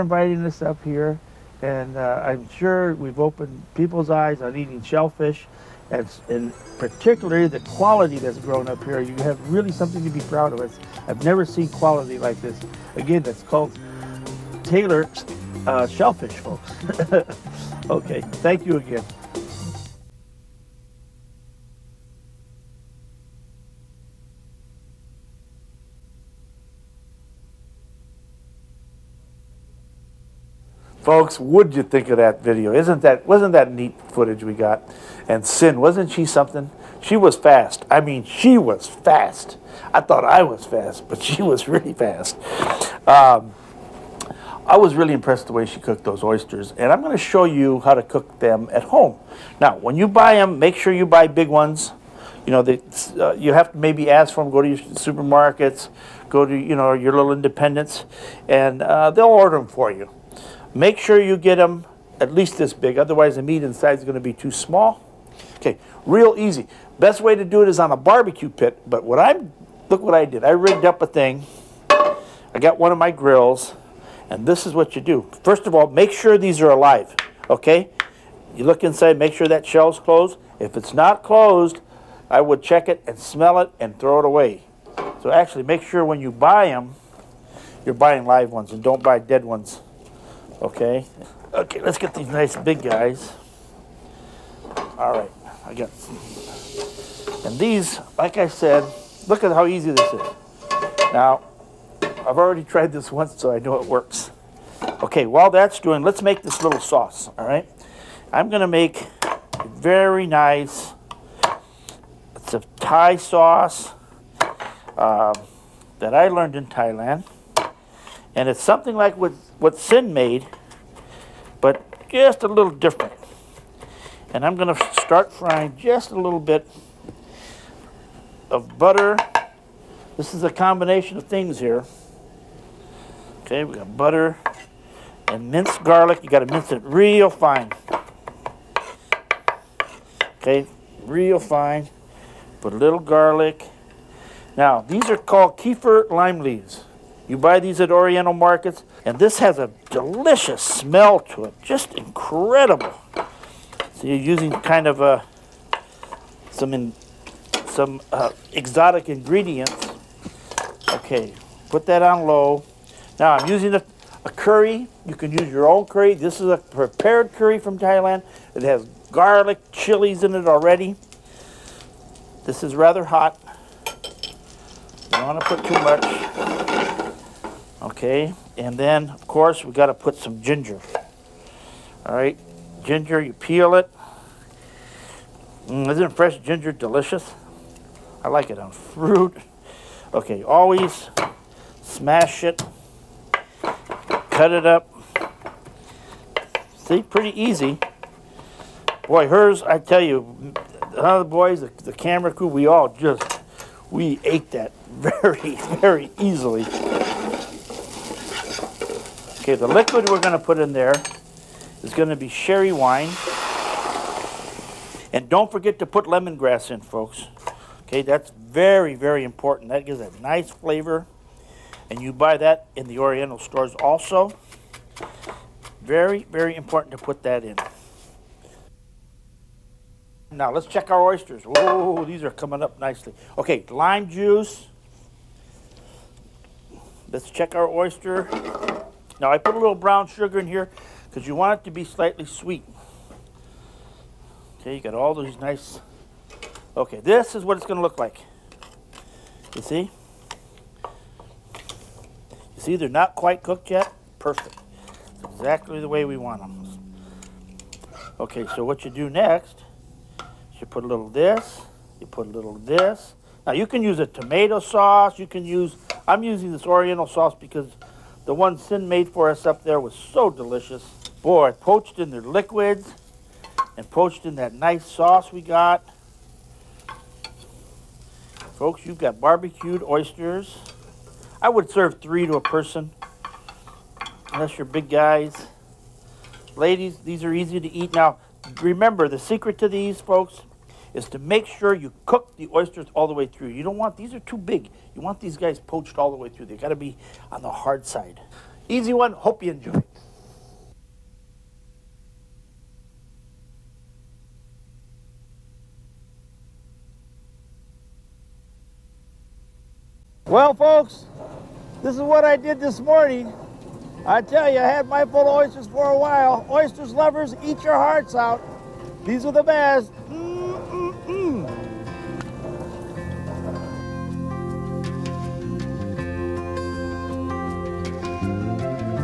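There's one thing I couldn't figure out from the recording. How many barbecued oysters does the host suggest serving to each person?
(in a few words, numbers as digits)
3.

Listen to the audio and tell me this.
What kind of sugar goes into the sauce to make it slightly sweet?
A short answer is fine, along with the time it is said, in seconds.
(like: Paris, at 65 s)
Brown sugar, at 239 s.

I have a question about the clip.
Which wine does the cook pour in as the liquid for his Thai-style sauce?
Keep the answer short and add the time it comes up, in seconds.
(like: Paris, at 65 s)
Sherry, at 212 s.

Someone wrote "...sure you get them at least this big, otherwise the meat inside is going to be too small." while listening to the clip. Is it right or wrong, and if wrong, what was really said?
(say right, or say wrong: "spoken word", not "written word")
right.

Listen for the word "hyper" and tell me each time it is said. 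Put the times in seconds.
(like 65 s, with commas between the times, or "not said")
not said.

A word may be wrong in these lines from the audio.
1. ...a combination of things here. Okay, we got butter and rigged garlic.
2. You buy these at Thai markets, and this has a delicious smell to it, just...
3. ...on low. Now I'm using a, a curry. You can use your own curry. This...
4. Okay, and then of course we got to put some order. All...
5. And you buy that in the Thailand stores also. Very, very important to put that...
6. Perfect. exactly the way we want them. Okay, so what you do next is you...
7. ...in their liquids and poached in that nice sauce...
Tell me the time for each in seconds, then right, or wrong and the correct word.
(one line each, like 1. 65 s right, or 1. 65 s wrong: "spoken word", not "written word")
1. 130 s wrong: "minced", not "rigged"
2. 147 s wrong: "Oriental", not "Thai"
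3. 162 s right
4. 178 s wrong: "ginger", not "order"
5. 221 s wrong: "Oriental", not "Thailand"
6. 254 s right
7. 271 s right.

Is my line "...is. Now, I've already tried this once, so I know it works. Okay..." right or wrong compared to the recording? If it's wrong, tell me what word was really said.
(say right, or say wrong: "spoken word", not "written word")
right.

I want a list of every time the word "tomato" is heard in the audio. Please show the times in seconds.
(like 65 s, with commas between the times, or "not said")
264 s.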